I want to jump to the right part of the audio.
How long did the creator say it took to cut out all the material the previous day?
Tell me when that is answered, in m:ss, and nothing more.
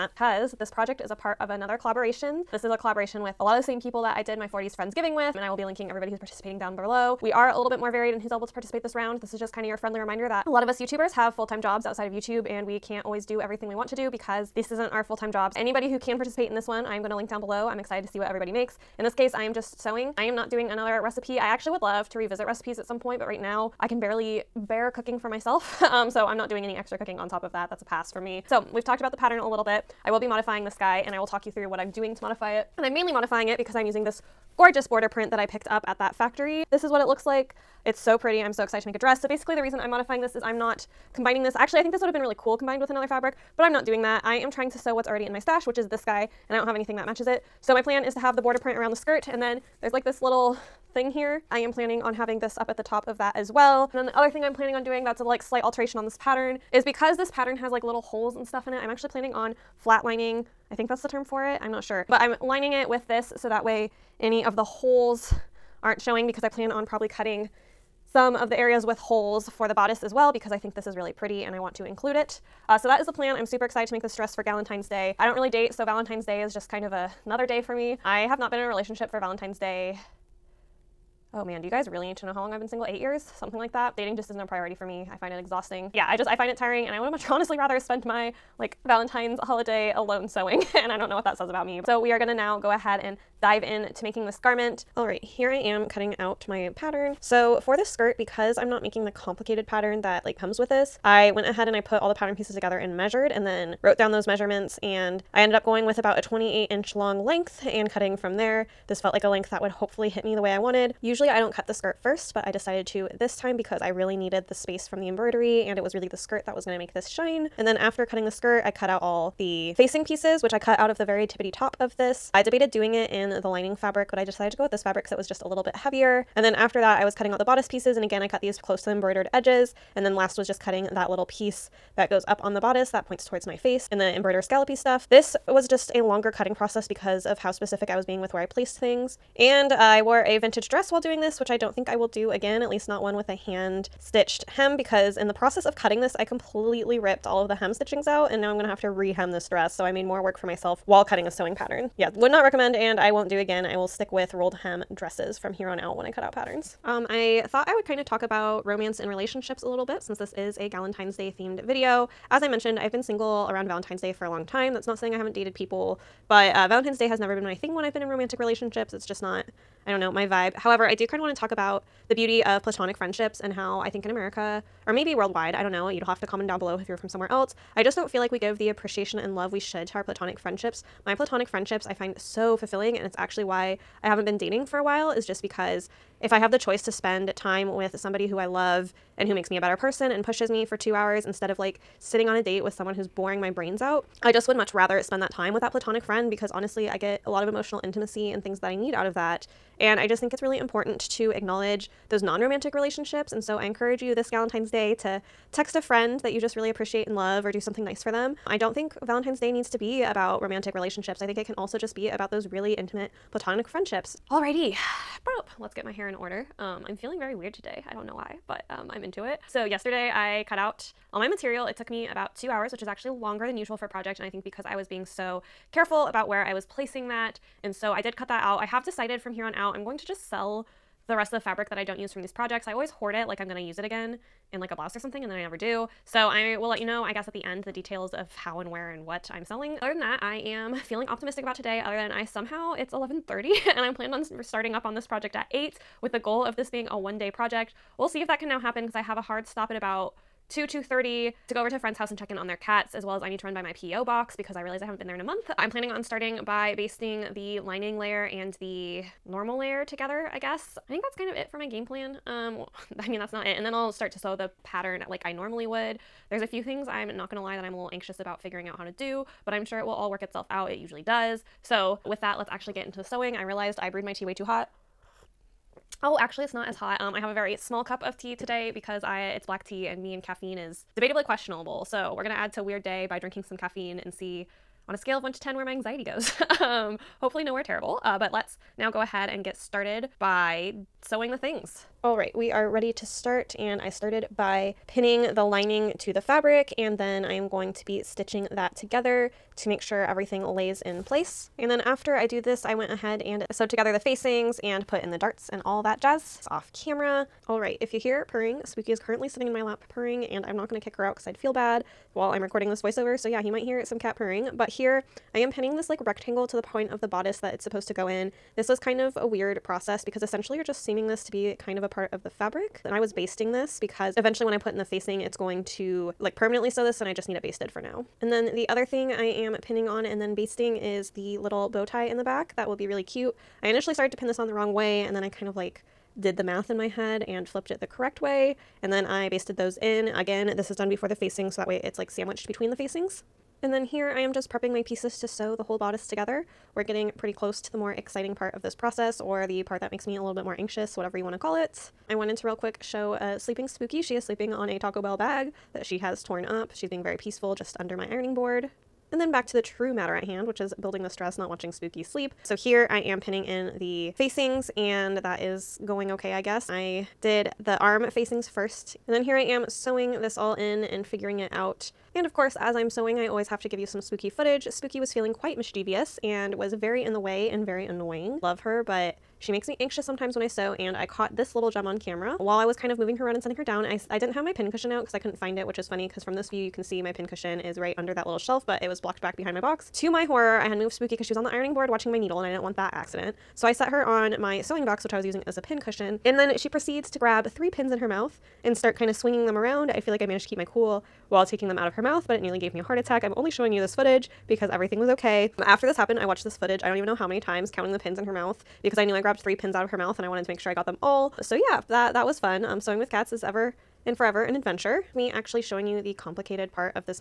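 3:42.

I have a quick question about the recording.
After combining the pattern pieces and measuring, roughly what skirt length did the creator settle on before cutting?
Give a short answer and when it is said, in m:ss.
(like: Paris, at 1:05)
28 inches, at 1:46.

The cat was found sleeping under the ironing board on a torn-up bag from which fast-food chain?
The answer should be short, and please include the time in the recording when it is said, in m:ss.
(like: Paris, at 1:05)
Taco Bell, at 5:54.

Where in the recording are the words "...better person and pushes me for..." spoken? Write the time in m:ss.
3:09.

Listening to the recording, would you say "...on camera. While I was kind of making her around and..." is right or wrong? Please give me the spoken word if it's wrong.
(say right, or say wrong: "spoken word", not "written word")
wrong: "moving", not "making".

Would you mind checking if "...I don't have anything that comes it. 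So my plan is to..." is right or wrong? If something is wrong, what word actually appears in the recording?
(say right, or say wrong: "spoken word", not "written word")
wrong: "matches", not "comes".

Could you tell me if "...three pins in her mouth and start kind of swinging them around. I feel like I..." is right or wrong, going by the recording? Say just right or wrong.
right.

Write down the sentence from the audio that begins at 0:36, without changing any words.
This is what it looks like.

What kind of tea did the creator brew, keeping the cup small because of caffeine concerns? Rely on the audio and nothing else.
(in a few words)
Black tea.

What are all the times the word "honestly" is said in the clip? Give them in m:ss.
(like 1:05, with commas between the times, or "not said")
1:27, 3:16.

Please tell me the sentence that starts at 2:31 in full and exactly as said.
Yeah, would not recommend, and I won't do again.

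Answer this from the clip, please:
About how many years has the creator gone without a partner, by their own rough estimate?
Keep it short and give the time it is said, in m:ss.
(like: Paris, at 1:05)
8, at 1:22.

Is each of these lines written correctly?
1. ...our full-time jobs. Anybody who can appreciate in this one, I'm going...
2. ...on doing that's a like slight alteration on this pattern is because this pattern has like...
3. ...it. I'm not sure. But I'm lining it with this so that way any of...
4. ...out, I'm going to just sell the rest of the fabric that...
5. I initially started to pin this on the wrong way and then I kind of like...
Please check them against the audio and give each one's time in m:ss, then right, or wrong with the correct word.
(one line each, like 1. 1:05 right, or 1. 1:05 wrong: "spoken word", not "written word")
1. 0:14 wrong: "participate", not "appreciate"
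2. 0:54 right
3. 1:01 right
4. 3:49 right
5. 5:33 right.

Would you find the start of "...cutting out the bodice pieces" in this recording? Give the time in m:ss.
2:07.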